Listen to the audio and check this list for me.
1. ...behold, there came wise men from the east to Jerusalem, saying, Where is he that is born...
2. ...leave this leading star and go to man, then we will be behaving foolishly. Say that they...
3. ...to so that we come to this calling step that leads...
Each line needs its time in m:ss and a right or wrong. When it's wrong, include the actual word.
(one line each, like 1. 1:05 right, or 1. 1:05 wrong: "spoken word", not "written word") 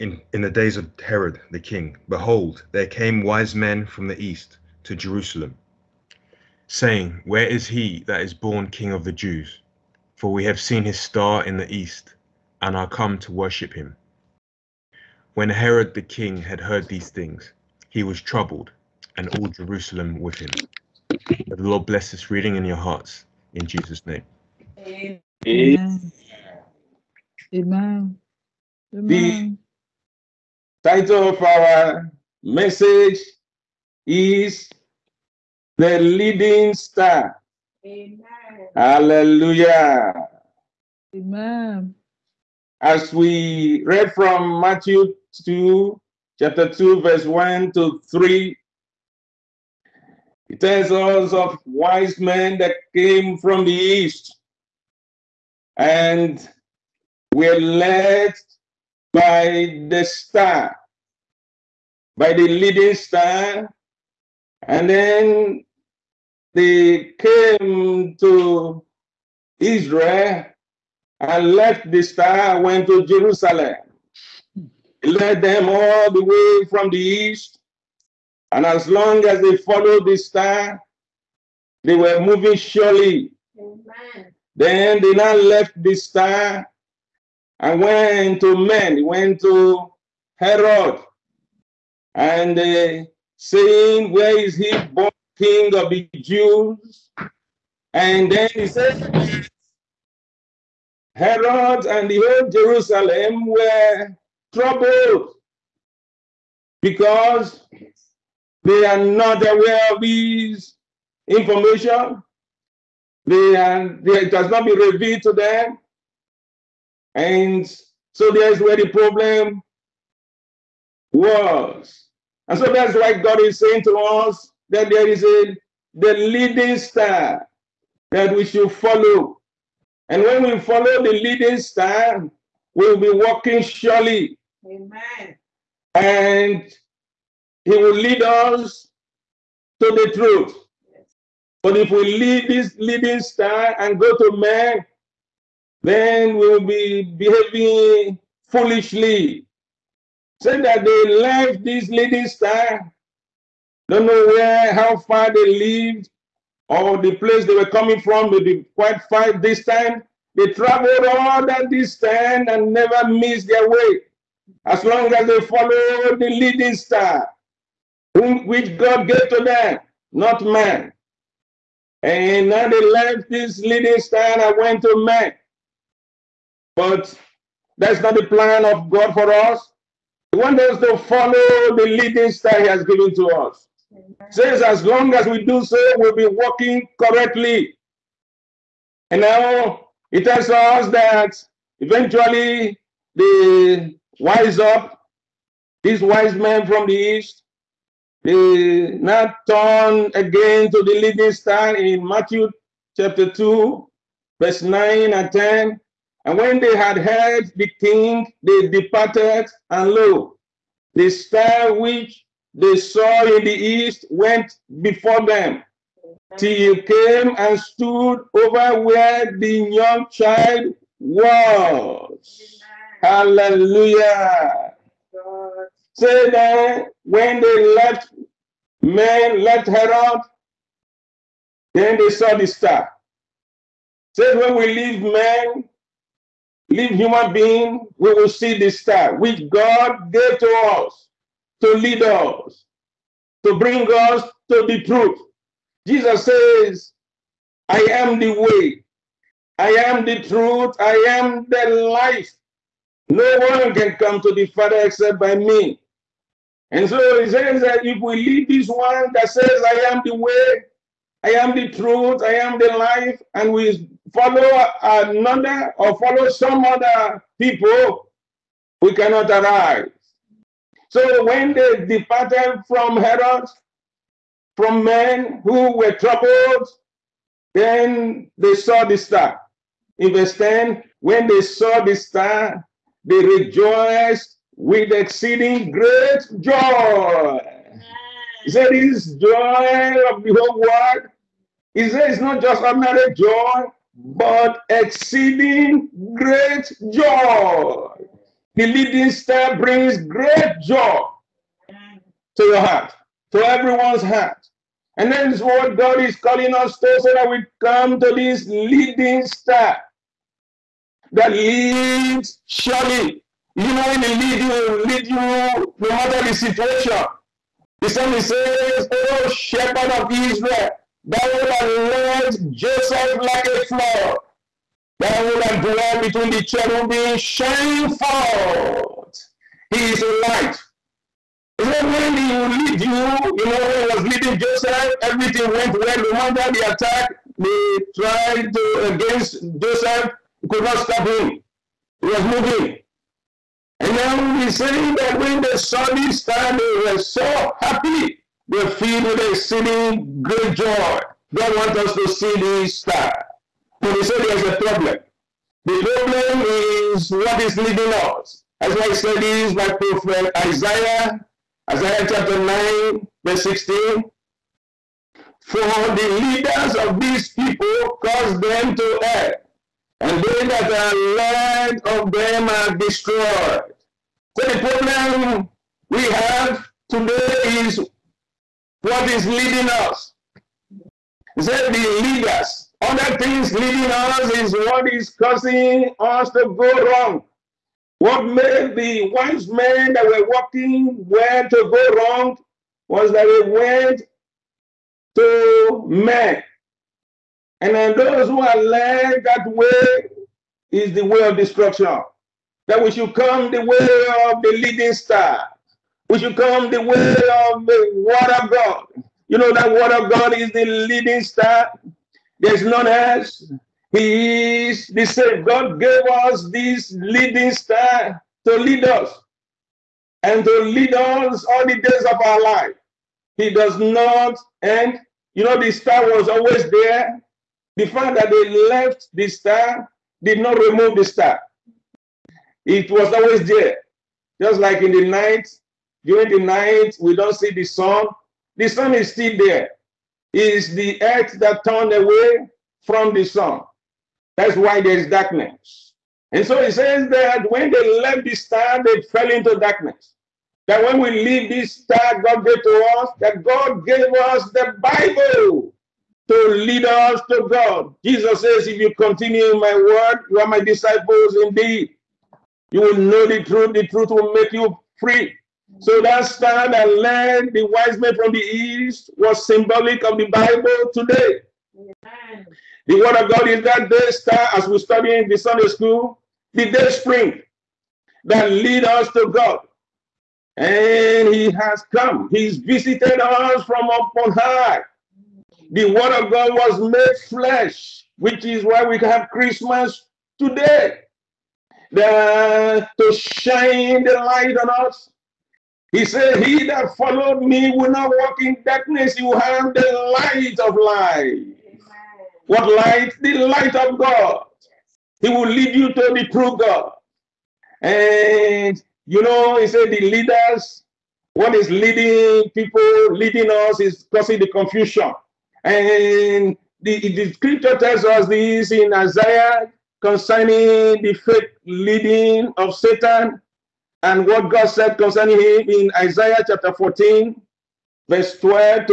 1. 0:02 right
2. 2:22 right
3. 5:06 wrong: "leading", not "calling".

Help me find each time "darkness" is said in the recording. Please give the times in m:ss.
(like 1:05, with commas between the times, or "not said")
7:25, 7:29, 8:18.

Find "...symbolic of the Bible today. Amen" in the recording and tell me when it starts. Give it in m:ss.
7:49.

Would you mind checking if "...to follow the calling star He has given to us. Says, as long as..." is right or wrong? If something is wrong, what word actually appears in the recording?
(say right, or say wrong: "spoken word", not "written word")
wrong: "leading", not "calling".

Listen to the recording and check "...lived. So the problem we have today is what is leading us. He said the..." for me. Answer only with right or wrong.
wrong.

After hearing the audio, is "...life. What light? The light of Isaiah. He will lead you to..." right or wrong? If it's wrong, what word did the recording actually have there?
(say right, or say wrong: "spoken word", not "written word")
wrong: "God", not "Isaiah".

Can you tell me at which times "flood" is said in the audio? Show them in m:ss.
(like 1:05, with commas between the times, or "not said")
5:23.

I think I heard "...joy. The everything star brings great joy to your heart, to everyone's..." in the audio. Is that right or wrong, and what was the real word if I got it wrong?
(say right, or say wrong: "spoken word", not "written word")
wrong: "leading", not "everything".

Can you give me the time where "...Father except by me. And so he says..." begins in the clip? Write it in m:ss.
4:14.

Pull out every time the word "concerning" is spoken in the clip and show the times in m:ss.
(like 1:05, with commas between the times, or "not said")
8:40, 8:44.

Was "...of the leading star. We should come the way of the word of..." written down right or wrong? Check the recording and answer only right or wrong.
right.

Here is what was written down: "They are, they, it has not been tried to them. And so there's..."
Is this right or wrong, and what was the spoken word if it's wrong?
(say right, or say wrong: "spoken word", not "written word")
wrong: "revealed", not "tried".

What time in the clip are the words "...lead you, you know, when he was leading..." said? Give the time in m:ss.
5:32.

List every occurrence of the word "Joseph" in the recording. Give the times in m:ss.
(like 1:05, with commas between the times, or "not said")
5:22, 5:34, 5:39.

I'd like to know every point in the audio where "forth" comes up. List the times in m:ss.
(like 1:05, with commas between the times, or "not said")
5:27.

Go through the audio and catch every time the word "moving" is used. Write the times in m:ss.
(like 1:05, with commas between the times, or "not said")
1:22, 5:42.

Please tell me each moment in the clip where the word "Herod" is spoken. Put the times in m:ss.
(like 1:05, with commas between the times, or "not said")
0:01, 0:15, 1:30, 1:41, 3:49, 4:32.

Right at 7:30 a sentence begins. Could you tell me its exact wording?
That when we leave this star God gave to us, that God gave us the Bible to lead us to God.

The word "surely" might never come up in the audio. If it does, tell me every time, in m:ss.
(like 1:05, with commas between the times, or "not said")
1:22, 2:13, 5:12.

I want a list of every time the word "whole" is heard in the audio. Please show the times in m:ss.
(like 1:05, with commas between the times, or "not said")
1:42, 4:50.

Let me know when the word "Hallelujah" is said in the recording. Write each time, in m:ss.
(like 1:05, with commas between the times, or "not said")
0:38, 3:43.